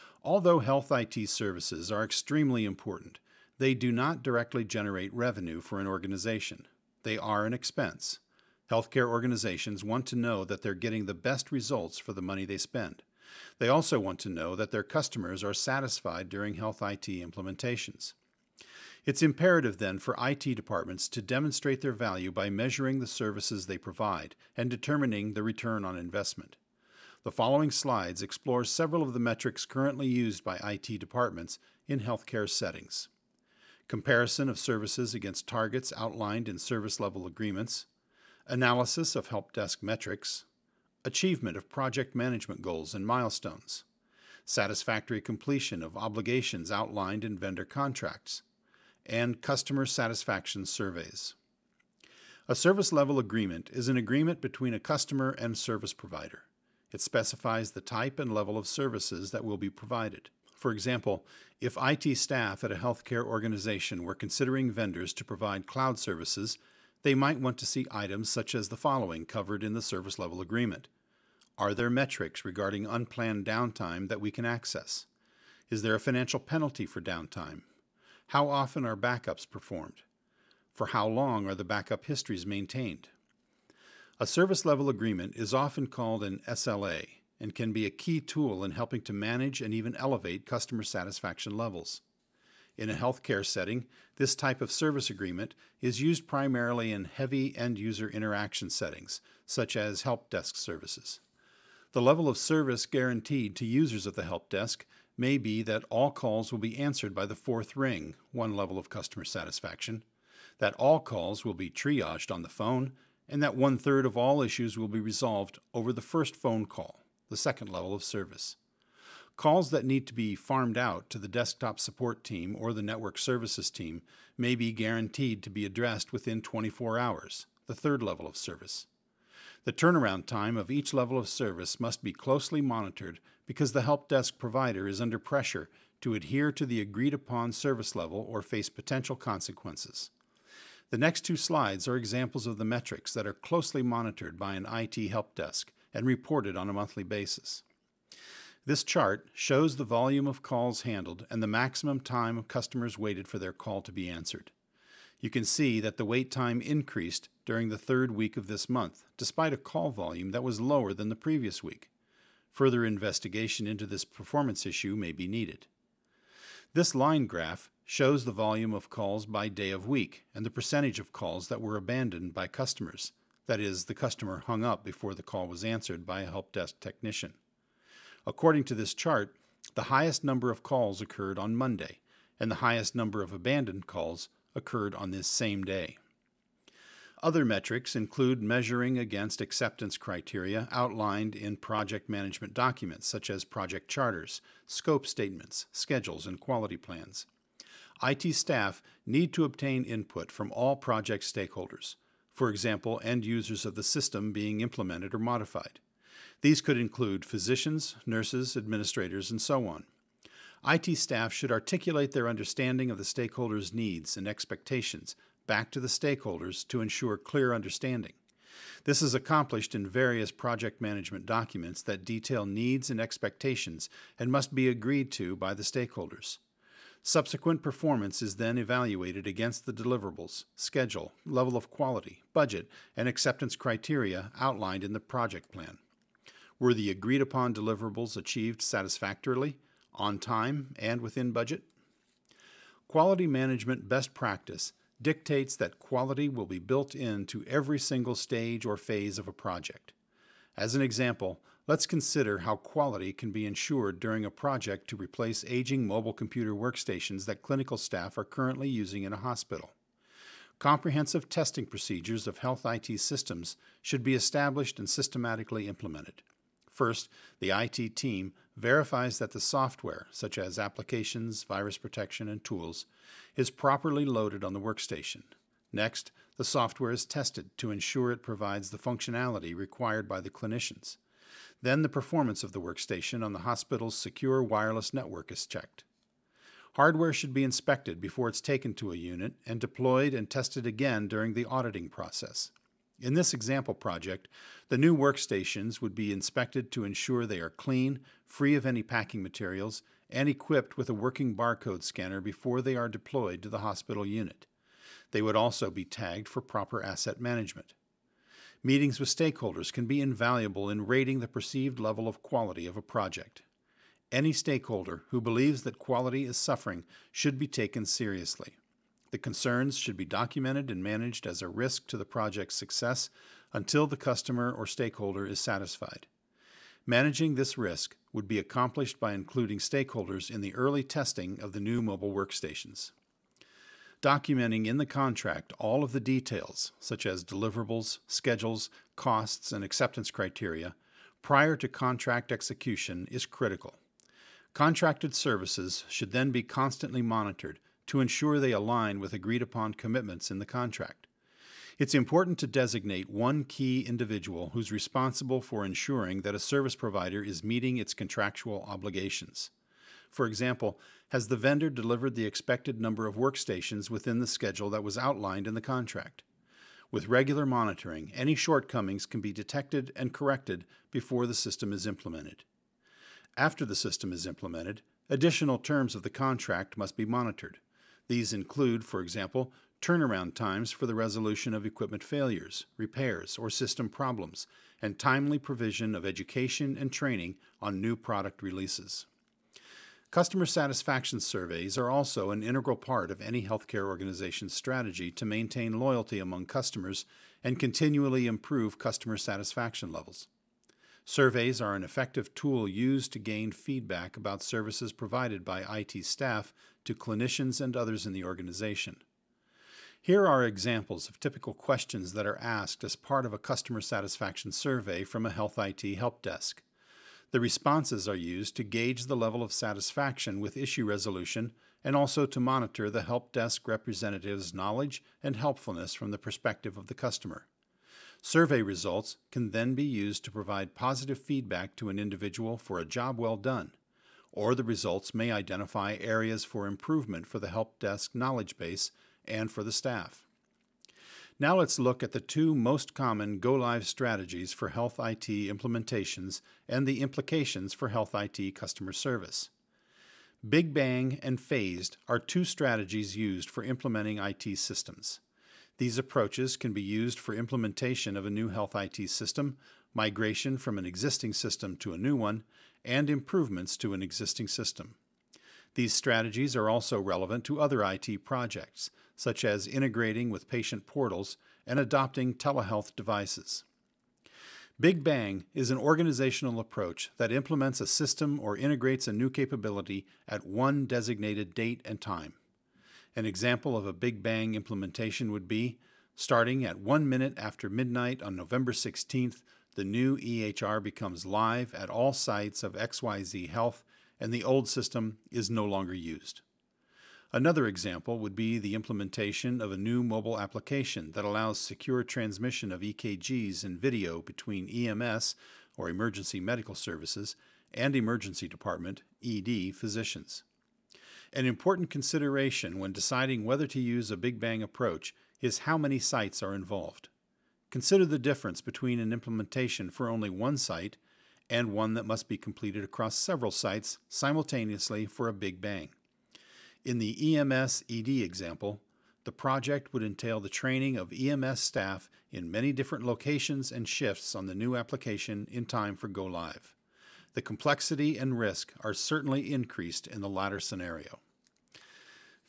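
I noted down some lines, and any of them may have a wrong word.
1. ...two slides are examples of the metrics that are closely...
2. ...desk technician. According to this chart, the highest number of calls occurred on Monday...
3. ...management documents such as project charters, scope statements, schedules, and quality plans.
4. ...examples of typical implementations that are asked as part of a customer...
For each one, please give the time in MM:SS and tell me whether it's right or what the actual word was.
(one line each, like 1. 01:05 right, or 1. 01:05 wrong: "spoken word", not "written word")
1. 02:21 right
2. 02:56 right
3. 03:12 right
4. 06:50 wrong: "questions", not "implementations".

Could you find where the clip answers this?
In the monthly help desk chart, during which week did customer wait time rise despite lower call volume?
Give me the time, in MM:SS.
02:37.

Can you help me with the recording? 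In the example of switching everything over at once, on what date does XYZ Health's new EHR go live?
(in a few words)
November 16th.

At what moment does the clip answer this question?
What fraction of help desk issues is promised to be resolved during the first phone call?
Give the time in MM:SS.
01:53.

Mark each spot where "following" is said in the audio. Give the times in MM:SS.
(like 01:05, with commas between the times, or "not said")
00:27, 01:08.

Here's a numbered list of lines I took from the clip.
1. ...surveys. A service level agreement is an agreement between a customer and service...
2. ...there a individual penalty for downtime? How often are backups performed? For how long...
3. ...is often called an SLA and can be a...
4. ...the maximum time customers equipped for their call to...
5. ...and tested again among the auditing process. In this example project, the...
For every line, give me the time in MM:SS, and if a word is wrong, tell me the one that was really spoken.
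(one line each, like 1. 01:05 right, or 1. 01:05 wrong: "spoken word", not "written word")
1. 00:50 right
2. 01:15 wrong: "financial", not "individual"
3. 01:25 right
4. 02:31 wrong: "waited", not "equipped"
5. 04:50 wrong: "during", not "among".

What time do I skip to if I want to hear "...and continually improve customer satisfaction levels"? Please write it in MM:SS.
06:37.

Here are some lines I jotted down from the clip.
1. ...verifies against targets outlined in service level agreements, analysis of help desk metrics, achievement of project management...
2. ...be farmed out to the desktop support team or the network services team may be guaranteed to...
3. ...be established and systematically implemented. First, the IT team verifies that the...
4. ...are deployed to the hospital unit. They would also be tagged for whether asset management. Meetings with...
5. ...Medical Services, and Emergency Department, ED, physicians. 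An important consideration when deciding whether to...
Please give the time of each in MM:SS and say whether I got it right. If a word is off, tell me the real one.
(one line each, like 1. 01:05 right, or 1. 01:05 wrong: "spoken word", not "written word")
1. 00:34 wrong: "services", not "verifies"
2. 02:00 right
3. 04:24 right
4. 05:02 wrong: "proper", not "whether"
5. 08:26 right.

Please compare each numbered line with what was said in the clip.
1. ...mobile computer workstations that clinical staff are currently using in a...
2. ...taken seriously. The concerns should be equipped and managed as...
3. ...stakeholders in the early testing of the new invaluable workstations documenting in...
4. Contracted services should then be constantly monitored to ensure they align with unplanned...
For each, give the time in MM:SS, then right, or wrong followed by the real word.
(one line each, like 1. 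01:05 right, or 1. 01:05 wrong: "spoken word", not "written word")
1. 04:15 right
2. 05:17 wrong: "documented", not "equipped"
3. 05:29 wrong: "mobile", not "invaluable"
4. 05:44 wrong: "agreed", not "unplanned".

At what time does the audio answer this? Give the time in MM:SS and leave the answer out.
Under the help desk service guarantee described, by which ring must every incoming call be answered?
01:47.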